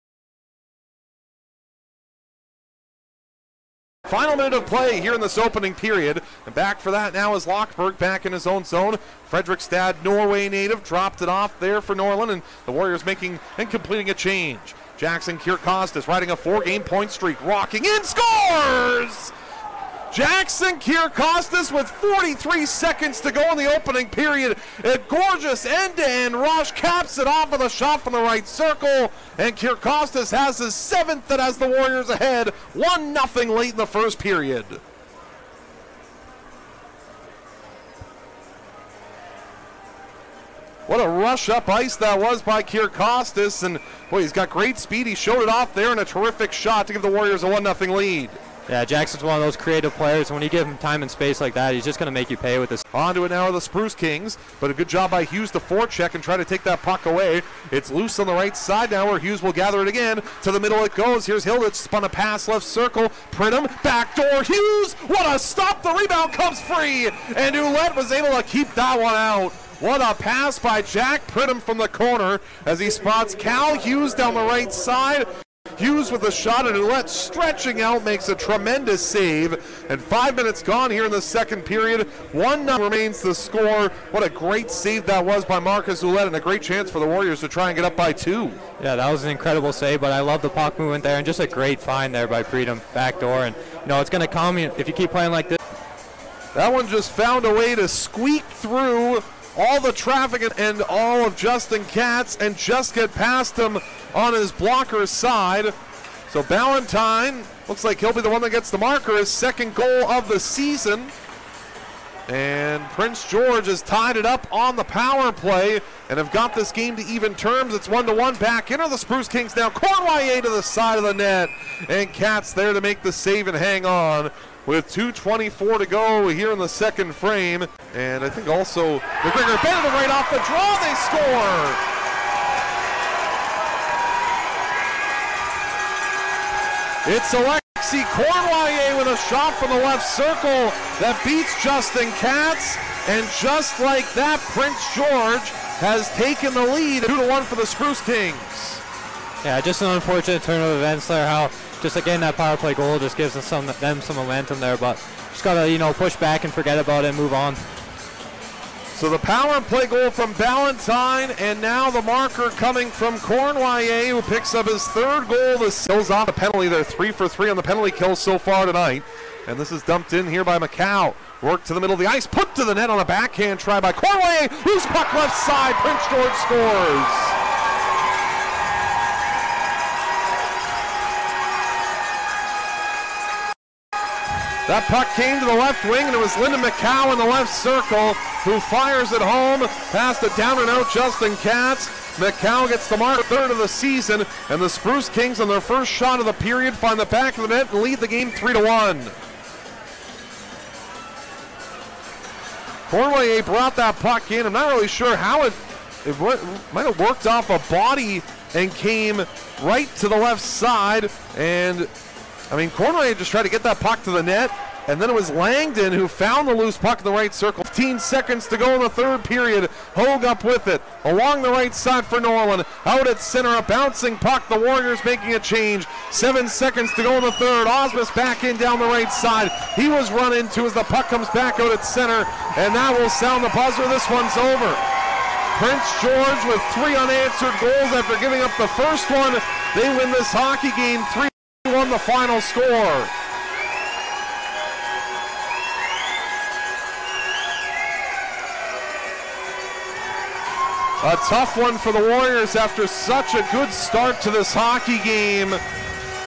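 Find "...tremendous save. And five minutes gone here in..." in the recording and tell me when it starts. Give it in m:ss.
1:18.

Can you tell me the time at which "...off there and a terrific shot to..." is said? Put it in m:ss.
0:45.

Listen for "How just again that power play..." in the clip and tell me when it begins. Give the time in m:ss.
2:31.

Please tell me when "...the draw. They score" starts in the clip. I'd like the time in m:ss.
2:10.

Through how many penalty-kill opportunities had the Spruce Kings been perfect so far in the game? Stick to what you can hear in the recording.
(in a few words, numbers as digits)
3.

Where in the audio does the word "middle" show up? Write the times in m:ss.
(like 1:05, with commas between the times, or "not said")
1:00, 2:51.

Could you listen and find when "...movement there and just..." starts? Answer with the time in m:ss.
1:30.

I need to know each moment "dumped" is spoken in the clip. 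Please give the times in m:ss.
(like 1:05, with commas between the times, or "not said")
2:49.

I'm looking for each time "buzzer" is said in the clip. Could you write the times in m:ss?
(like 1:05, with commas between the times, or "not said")
3:53.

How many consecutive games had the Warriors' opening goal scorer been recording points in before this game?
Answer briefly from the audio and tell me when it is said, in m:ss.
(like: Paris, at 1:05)
4, at 0:16.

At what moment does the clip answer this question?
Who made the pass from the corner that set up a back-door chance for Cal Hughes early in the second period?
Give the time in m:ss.
1:10.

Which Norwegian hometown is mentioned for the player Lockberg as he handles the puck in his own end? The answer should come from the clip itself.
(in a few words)
Fredrikstad.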